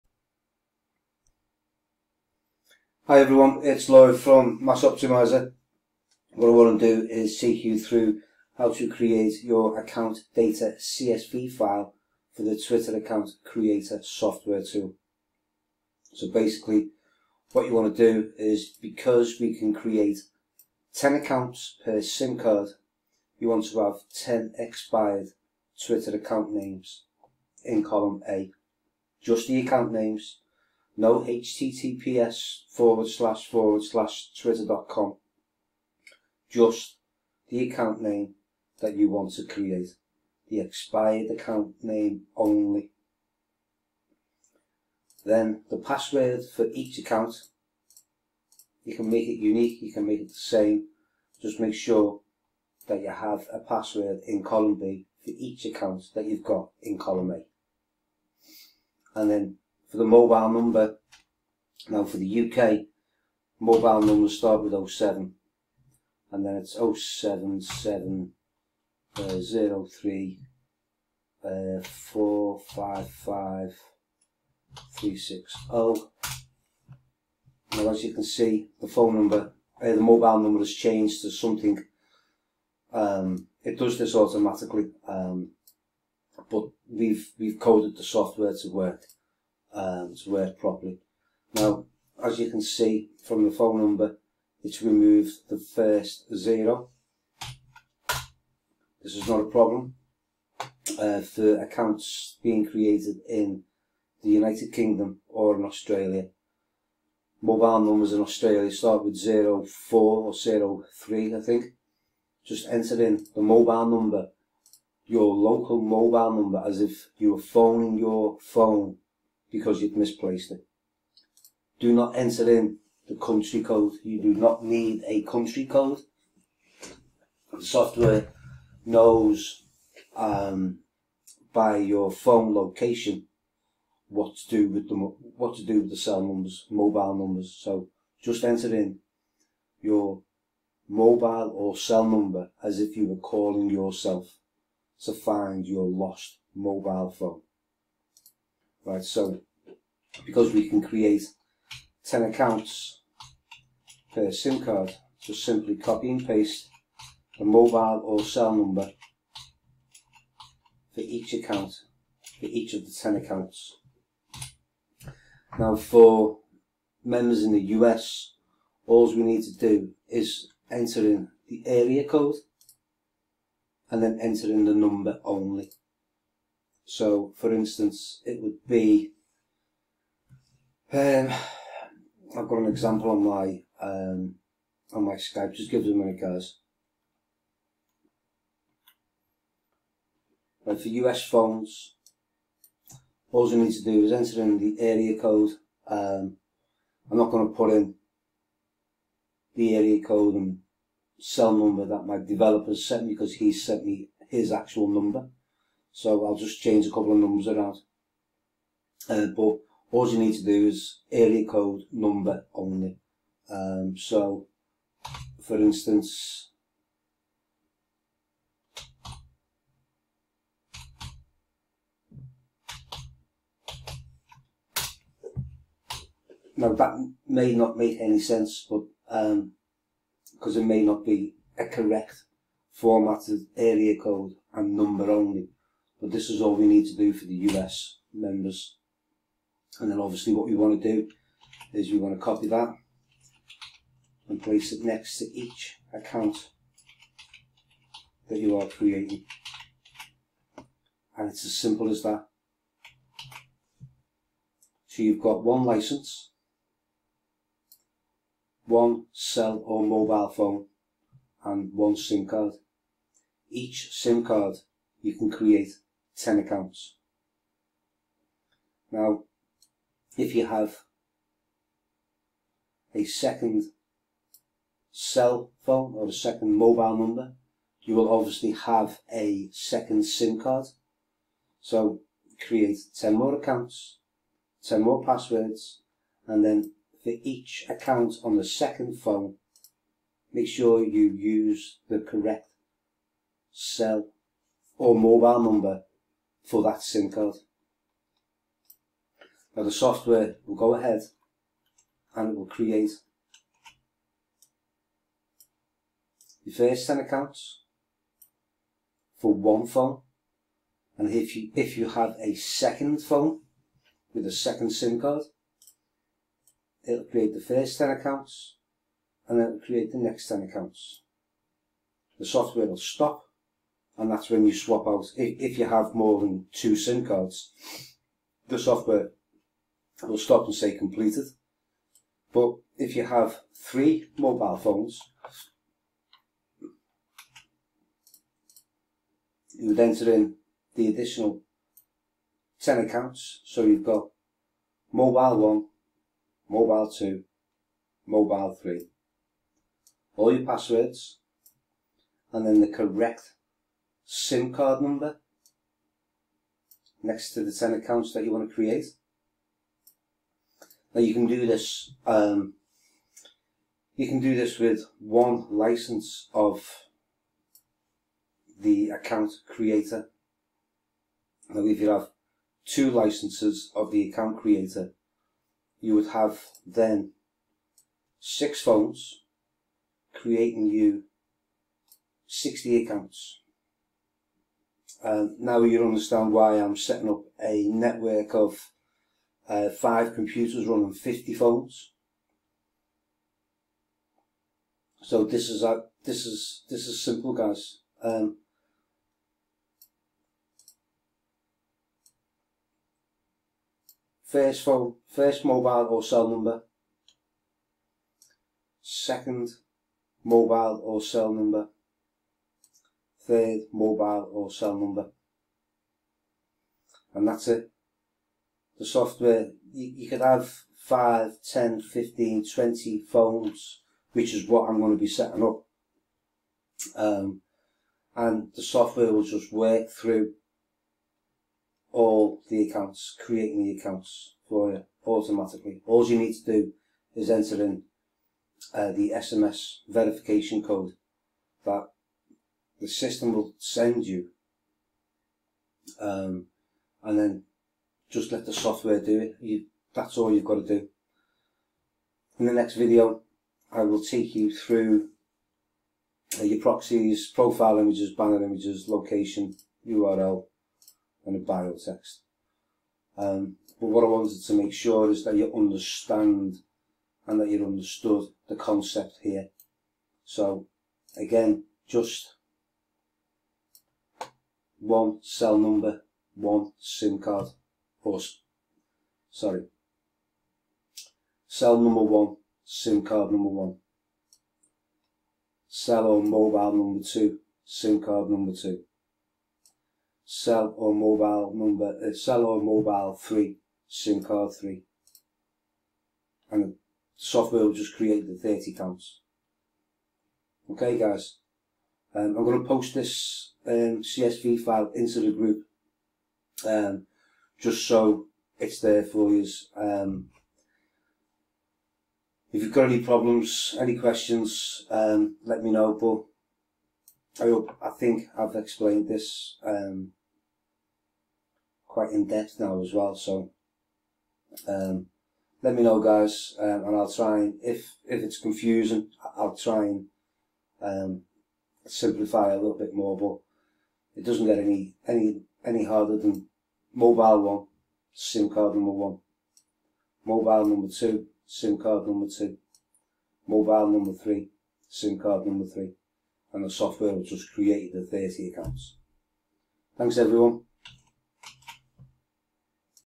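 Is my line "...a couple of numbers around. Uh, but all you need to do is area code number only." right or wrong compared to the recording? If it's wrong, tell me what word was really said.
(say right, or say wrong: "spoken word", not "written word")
right.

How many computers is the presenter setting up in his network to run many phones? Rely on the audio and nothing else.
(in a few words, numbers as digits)
5.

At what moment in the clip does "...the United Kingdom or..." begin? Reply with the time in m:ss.
1:44.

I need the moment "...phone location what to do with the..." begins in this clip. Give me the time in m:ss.
2:12.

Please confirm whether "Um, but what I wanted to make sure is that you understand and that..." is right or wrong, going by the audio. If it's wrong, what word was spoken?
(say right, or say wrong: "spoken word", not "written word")
right.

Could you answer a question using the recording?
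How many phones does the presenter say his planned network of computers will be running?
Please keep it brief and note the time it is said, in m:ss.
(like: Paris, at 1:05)
50, at 6:30.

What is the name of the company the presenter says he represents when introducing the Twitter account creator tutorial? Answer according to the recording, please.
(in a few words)
Mass Optimizer.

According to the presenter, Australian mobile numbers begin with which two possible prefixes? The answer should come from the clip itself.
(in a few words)
04 or 03.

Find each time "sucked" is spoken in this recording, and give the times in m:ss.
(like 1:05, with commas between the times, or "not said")
not said.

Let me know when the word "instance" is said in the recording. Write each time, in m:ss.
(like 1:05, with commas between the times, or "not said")
2:57, 3:35.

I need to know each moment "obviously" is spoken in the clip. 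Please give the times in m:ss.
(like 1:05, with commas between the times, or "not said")
3:59, 4:38.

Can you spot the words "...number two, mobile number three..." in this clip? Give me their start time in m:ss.
9:02.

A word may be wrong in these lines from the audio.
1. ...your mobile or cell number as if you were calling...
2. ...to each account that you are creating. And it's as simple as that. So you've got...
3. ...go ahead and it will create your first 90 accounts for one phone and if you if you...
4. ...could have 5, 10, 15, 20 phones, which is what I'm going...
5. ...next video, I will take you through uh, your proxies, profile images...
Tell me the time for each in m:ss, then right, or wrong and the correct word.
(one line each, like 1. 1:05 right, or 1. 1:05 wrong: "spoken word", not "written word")
1. 2:19 right
2. 4:05 right
3. 5:00 wrong: "10", not "90"
4. 7:00 right
5. 7:32 right.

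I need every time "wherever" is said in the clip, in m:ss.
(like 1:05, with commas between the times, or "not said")
not said.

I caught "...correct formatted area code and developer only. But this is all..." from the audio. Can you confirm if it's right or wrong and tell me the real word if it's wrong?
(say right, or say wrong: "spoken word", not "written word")
wrong: "number", not "developer".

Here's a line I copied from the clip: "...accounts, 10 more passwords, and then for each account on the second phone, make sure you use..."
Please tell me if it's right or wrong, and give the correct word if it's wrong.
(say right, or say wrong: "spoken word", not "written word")
right.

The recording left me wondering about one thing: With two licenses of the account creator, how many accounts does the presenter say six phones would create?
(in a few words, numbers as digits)
60.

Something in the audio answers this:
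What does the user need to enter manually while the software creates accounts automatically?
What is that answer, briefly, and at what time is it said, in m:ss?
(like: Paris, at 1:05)
SMS verification code, at 7:19.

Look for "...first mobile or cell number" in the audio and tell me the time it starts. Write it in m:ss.
6:45.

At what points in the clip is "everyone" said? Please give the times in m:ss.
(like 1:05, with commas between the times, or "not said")
0:03, 9:10.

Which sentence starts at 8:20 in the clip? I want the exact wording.
Okay guys, um, I'm going to post this um, CSV file into the group um, just so it's there for you.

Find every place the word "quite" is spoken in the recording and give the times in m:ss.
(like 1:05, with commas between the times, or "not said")
8:41.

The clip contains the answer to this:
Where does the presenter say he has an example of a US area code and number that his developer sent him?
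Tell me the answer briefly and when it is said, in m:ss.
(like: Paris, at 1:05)
Skype, at 3:05.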